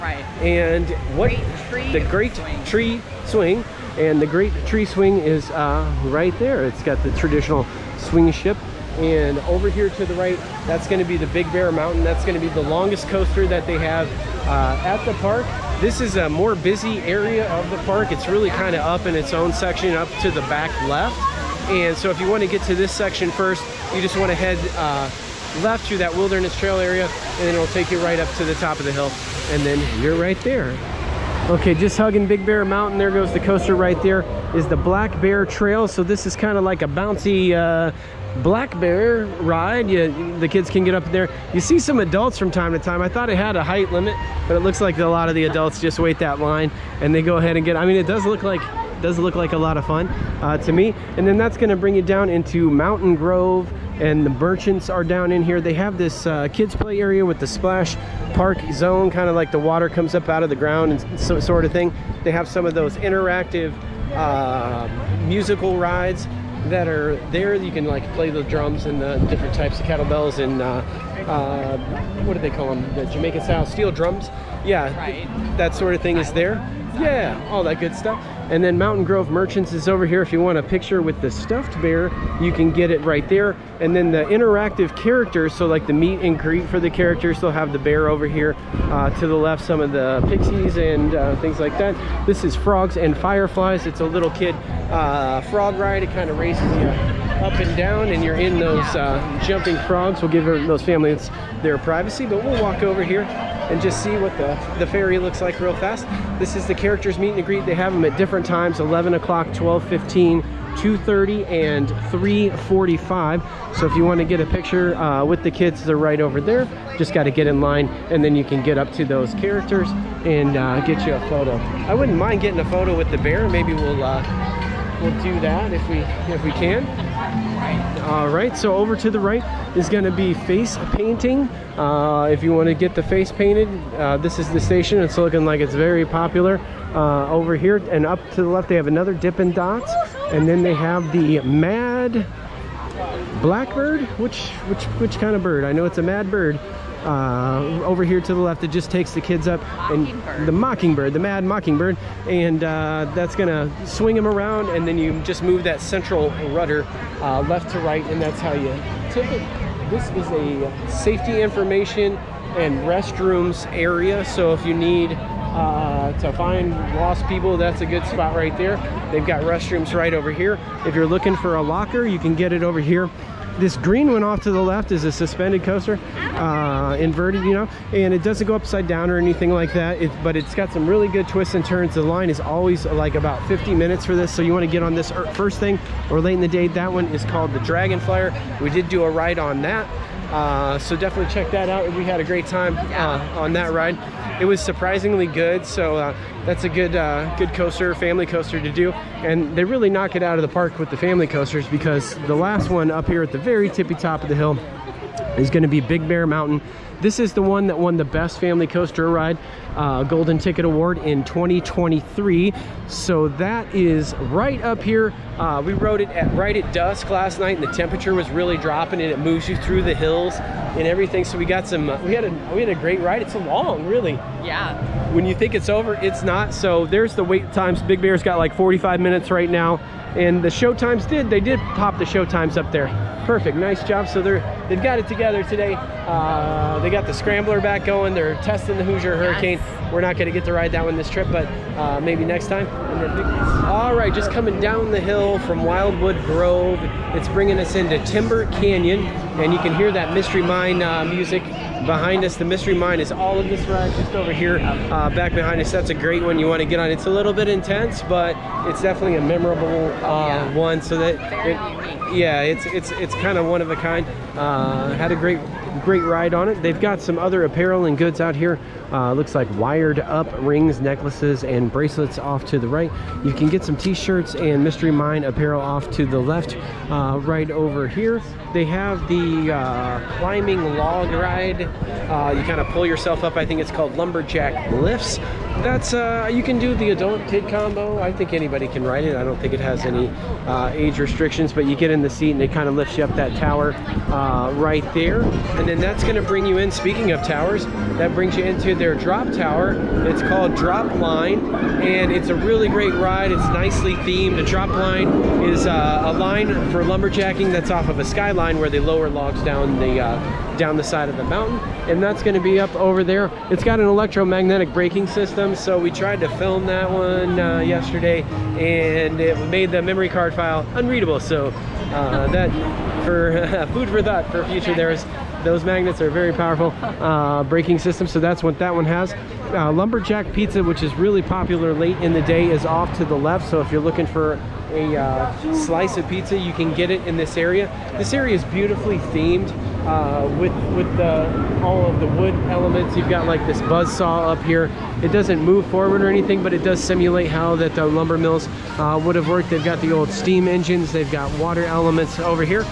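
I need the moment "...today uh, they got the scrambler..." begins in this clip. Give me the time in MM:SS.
03:55.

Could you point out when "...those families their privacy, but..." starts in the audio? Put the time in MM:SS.
01:40.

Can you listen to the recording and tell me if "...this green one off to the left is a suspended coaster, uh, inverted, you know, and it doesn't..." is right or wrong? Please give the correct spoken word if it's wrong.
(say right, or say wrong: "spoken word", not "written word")
right.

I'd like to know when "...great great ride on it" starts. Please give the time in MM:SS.
04:25.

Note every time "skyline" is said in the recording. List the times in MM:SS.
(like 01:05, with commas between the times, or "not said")
05:08.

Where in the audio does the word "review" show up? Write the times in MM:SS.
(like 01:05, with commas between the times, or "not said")
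not said.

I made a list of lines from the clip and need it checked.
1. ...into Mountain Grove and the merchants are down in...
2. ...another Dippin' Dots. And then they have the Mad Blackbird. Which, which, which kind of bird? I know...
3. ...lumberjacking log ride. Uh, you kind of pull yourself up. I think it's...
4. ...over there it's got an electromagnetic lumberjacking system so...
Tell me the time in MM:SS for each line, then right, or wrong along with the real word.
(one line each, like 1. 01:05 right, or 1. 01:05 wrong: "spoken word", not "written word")
1. 00:52 right
2. 02:18 right
3. 04:40 wrong: "climbing", not "lumberjacking"
4. 05:12 wrong: "braking", not "lumberjacking".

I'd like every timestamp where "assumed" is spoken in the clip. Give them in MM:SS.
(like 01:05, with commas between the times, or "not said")
not said.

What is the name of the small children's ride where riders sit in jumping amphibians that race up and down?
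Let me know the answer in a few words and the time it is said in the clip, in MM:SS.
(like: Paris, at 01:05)
Frogs and Fireflies, at 01:32.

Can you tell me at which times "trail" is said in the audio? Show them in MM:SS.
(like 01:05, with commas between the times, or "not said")
00:26, 00:35.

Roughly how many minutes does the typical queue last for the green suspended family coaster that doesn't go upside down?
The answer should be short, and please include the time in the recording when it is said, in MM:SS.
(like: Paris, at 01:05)
50 minutes, at 03:03.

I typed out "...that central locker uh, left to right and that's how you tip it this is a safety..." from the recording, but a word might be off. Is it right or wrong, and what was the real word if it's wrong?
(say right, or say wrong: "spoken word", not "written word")
wrong: "rudder", not "locker".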